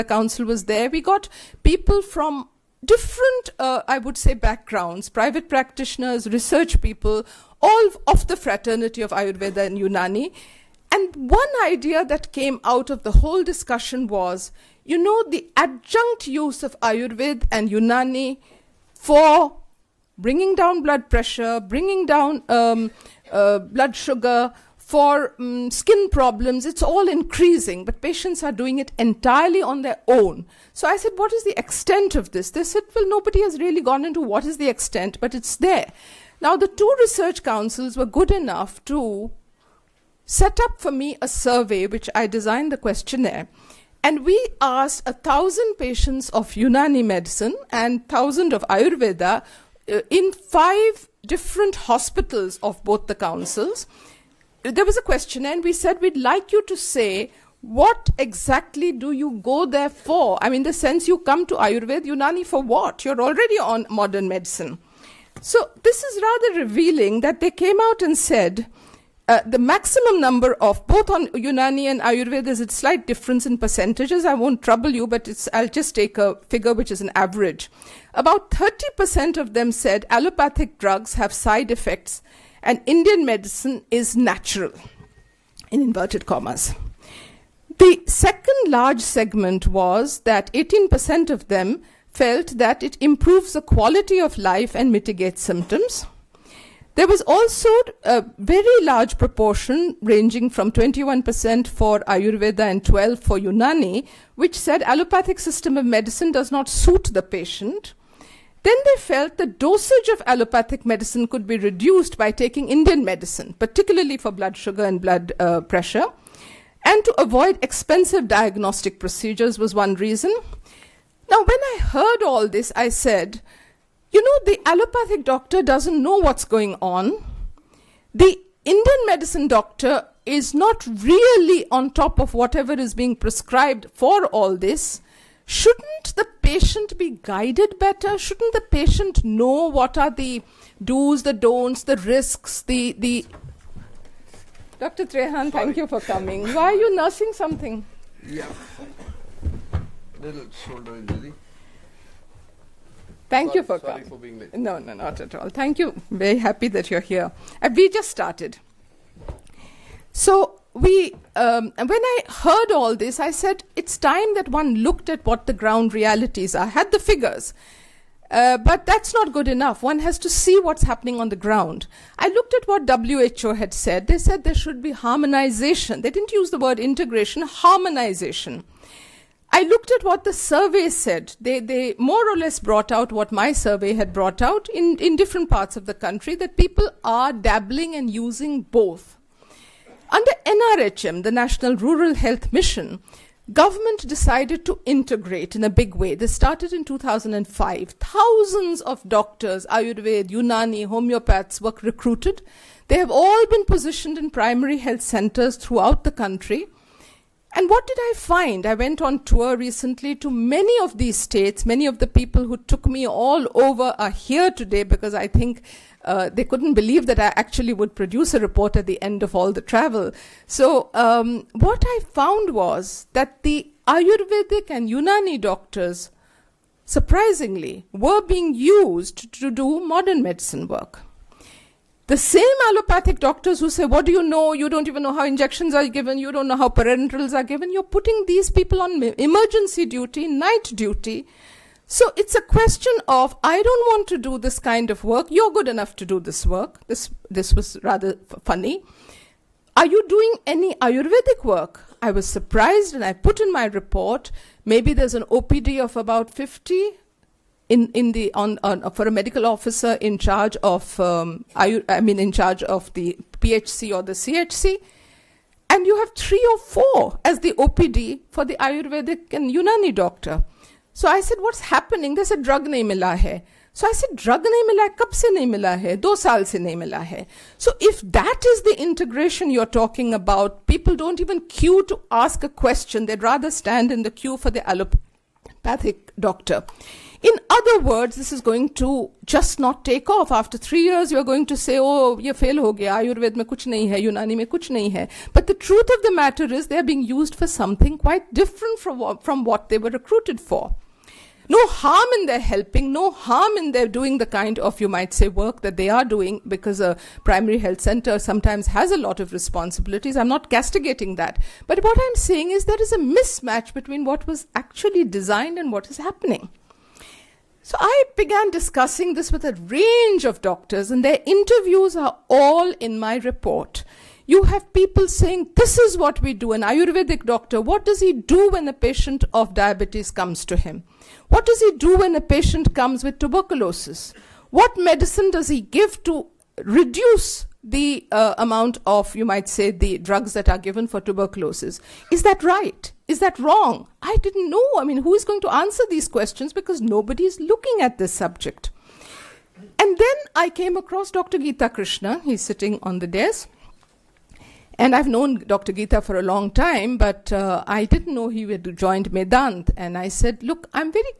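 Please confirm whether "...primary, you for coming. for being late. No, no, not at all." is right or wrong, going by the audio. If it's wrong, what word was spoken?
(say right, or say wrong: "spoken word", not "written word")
wrong: "sorry", not "primary".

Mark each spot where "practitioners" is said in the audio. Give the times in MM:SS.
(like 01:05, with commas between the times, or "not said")
00:05.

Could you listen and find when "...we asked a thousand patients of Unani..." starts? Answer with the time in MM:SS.
00:44.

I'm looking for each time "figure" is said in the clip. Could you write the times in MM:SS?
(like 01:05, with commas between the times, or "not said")
01:16, 02:46.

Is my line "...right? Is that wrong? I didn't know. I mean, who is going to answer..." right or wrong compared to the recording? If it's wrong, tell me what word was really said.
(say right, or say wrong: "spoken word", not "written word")
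right.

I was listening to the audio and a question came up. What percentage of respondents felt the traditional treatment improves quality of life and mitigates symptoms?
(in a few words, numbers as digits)
18%.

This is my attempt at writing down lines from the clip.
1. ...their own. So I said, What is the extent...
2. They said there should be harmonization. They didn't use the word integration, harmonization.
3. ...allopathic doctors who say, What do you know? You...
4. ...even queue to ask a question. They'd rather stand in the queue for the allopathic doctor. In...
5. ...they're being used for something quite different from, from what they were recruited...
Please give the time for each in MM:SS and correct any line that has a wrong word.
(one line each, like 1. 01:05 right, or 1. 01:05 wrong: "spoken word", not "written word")
1. 00:29 right
2. 02:54 right
3. 03:52 right
4. 04:41 right
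5. 04:56 right.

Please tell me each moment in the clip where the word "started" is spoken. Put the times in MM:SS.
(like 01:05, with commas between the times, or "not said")
02:38, 03:16.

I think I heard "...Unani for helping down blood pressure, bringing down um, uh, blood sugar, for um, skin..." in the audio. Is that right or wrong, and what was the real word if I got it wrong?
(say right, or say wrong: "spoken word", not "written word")
wrong: "bringing", not "helping".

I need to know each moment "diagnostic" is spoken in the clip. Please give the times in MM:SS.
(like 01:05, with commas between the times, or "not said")
01:58.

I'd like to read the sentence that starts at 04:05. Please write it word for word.
You're good enough to do this work.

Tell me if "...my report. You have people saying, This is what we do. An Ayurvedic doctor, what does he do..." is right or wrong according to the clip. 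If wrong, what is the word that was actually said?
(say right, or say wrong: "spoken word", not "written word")
right.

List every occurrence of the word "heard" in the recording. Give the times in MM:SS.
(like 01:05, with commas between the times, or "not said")
02:01, 02:42.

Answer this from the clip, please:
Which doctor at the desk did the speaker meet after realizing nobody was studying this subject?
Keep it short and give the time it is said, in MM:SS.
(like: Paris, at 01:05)
Dr. Geeta Krishna, at 05:51.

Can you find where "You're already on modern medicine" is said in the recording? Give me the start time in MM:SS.
01:03.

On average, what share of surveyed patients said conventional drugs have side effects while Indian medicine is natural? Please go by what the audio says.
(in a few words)
30%.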